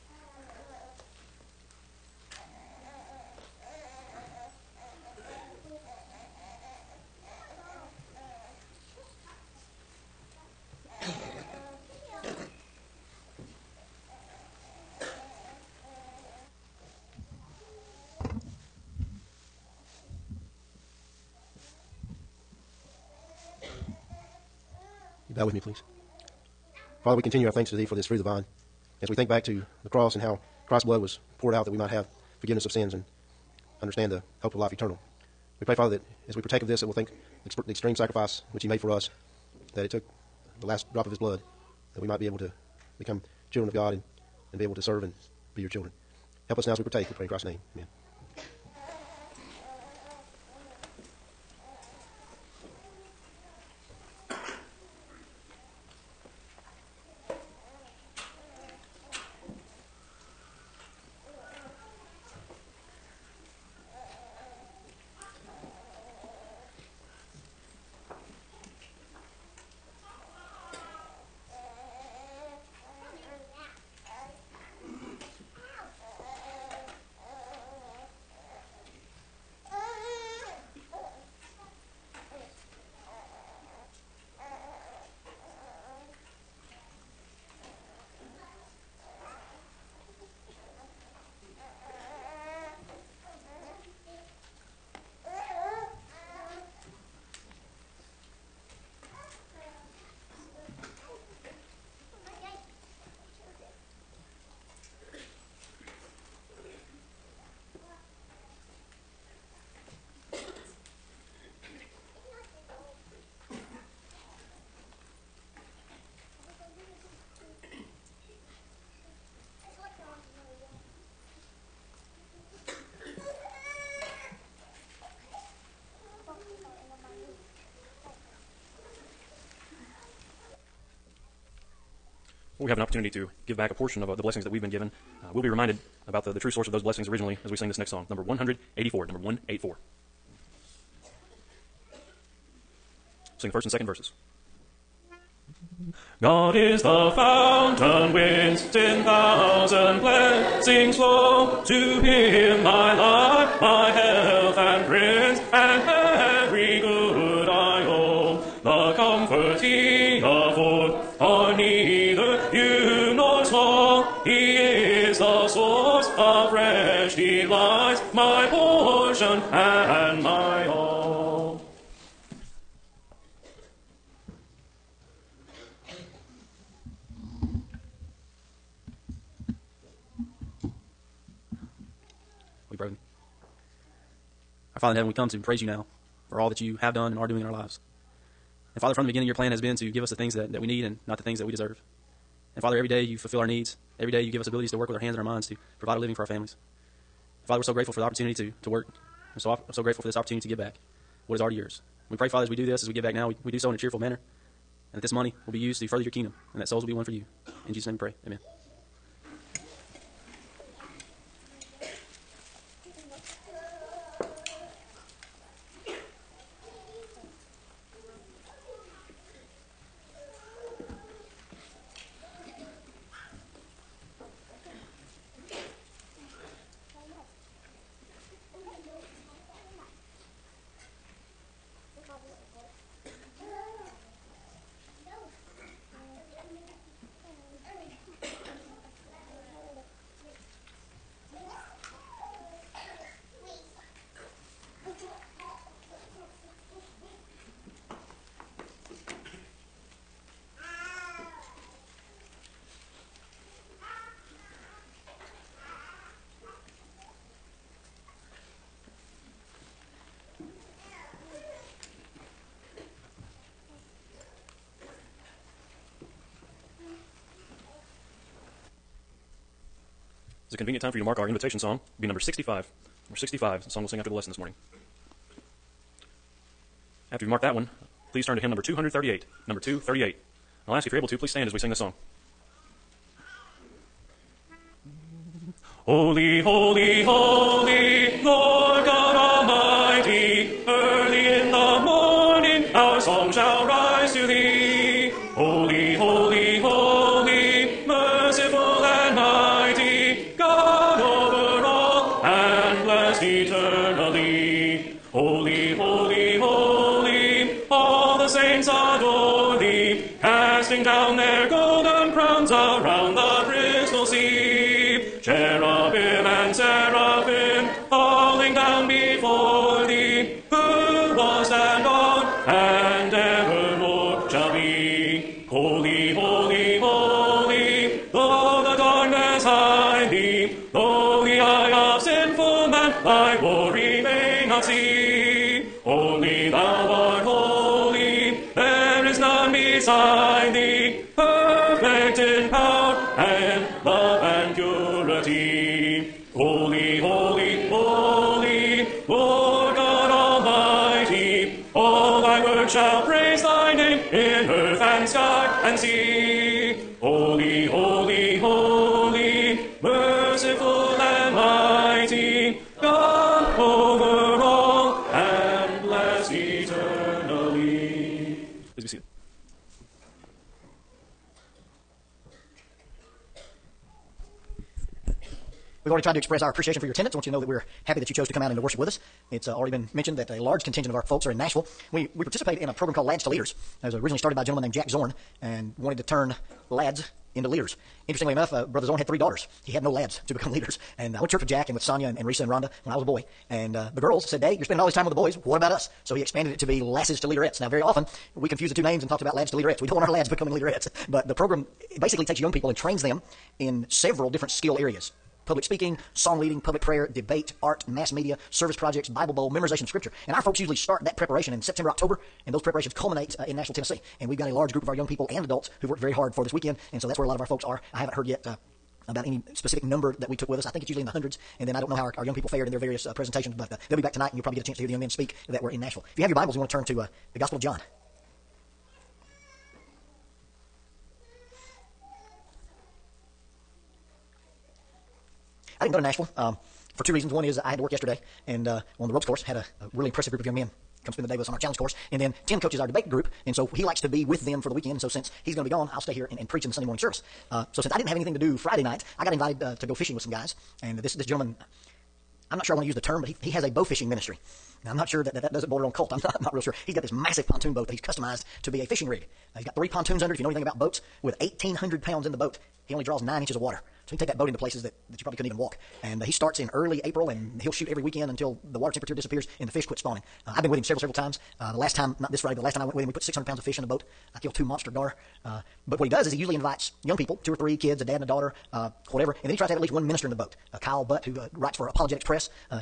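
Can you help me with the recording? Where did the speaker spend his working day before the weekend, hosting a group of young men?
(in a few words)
ropes course.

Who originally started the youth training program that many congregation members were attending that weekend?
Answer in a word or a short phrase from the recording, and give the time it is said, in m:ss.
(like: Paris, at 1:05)
Jack Zorn, at 6:24.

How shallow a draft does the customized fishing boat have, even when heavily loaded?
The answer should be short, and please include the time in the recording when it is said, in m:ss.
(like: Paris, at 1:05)
9 inches, at 7:43.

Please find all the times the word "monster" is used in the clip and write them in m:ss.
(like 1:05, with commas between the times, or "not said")
7:54.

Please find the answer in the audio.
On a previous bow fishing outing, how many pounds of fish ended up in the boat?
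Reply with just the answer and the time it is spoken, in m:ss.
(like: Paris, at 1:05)
600, at 7:53.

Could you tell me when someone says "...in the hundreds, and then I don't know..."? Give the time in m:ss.
7:01.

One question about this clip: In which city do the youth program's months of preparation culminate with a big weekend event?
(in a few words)
Nashville, Tennessee.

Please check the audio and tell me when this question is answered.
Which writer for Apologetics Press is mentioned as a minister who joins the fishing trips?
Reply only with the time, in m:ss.
8:00.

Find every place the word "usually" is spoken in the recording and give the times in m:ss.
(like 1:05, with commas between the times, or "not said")
6:50, 7:00, 7:56.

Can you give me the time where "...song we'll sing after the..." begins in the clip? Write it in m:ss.
4:33.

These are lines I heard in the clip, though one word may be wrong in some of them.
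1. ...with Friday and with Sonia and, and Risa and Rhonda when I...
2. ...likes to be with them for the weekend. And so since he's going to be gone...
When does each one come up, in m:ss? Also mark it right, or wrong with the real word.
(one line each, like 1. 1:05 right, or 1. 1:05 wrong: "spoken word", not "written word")
1. 6:31 wrong: "Jack", not "Friday"
2. 7:23 right.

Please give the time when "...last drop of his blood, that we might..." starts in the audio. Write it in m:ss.
0:40.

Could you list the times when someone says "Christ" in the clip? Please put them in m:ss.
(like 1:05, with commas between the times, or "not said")
0:30, 0:47.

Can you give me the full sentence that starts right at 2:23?
Sing the first and second verses.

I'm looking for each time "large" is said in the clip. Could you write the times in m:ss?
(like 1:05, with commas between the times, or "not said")
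6:20, 6:54.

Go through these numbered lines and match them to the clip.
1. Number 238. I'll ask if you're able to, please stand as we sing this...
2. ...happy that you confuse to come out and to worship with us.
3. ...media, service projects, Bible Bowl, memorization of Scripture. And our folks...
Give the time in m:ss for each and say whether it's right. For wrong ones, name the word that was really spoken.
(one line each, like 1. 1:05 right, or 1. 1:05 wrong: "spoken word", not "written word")
1. 4:39 right
2. 6:17 wrong: "chose", not "confuse"
3. 6:48 right.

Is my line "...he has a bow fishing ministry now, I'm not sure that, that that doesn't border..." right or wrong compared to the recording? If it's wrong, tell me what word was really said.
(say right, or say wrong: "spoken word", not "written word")
right.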